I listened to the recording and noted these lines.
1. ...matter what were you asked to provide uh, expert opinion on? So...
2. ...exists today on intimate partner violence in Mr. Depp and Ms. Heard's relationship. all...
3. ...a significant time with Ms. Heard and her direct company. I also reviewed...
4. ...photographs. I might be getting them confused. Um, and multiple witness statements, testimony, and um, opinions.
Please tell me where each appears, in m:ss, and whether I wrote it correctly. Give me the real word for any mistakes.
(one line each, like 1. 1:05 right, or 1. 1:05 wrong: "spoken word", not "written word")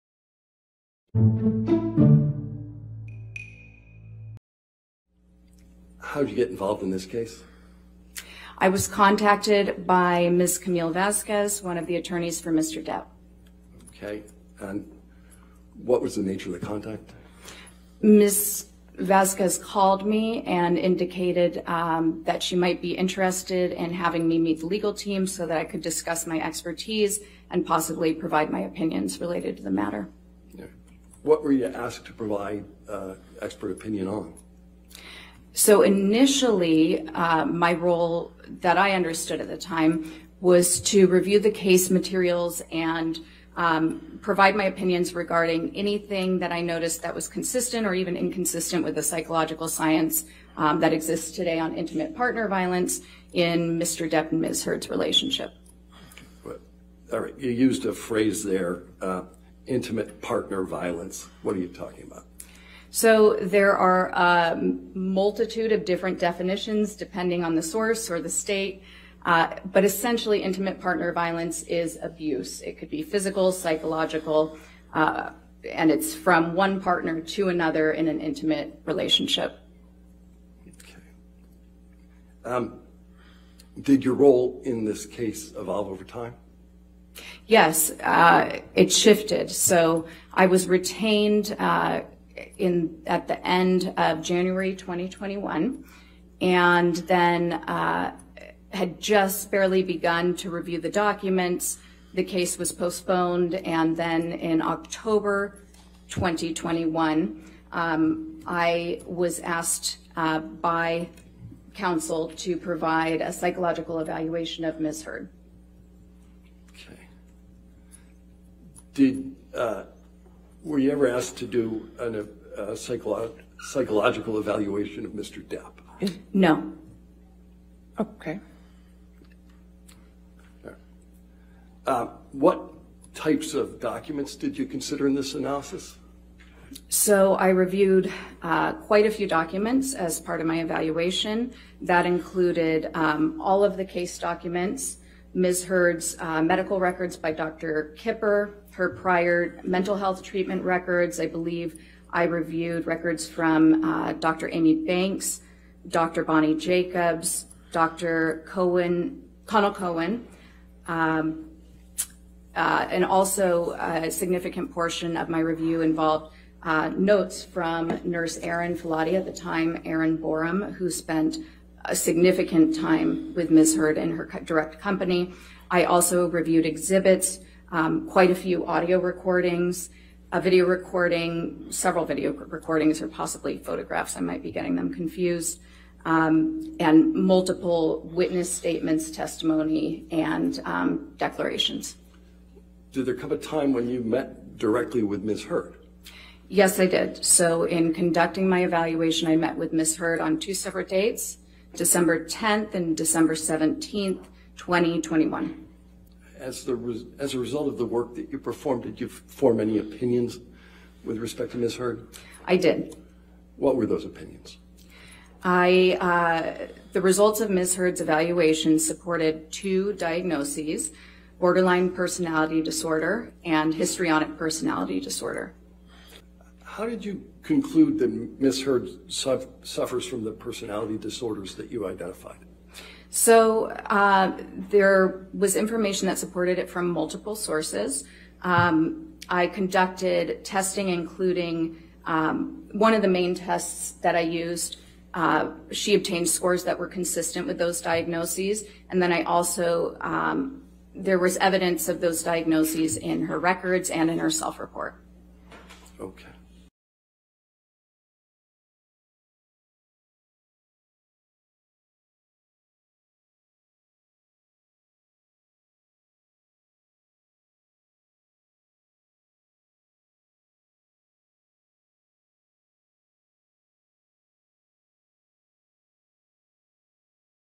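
1. 0:29 right
2. 0:50 right
3. 2:51 right
4. 3:03 wrong: "declarations", not "opinions".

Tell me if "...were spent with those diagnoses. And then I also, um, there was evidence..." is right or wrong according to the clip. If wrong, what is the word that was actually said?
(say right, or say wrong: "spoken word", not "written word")
wrong: "consistent", not "spent".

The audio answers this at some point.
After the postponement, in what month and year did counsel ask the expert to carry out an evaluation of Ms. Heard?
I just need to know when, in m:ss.
1:44.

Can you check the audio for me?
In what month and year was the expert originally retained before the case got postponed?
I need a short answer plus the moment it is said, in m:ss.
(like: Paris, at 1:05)
January 2021, at 1:34.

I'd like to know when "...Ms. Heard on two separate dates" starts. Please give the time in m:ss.
3:19.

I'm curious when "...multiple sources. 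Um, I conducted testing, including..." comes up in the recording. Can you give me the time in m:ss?
3:56.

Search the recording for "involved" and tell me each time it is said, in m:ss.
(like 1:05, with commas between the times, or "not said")
0:06, 2:45.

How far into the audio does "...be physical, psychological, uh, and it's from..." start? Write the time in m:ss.
1:12.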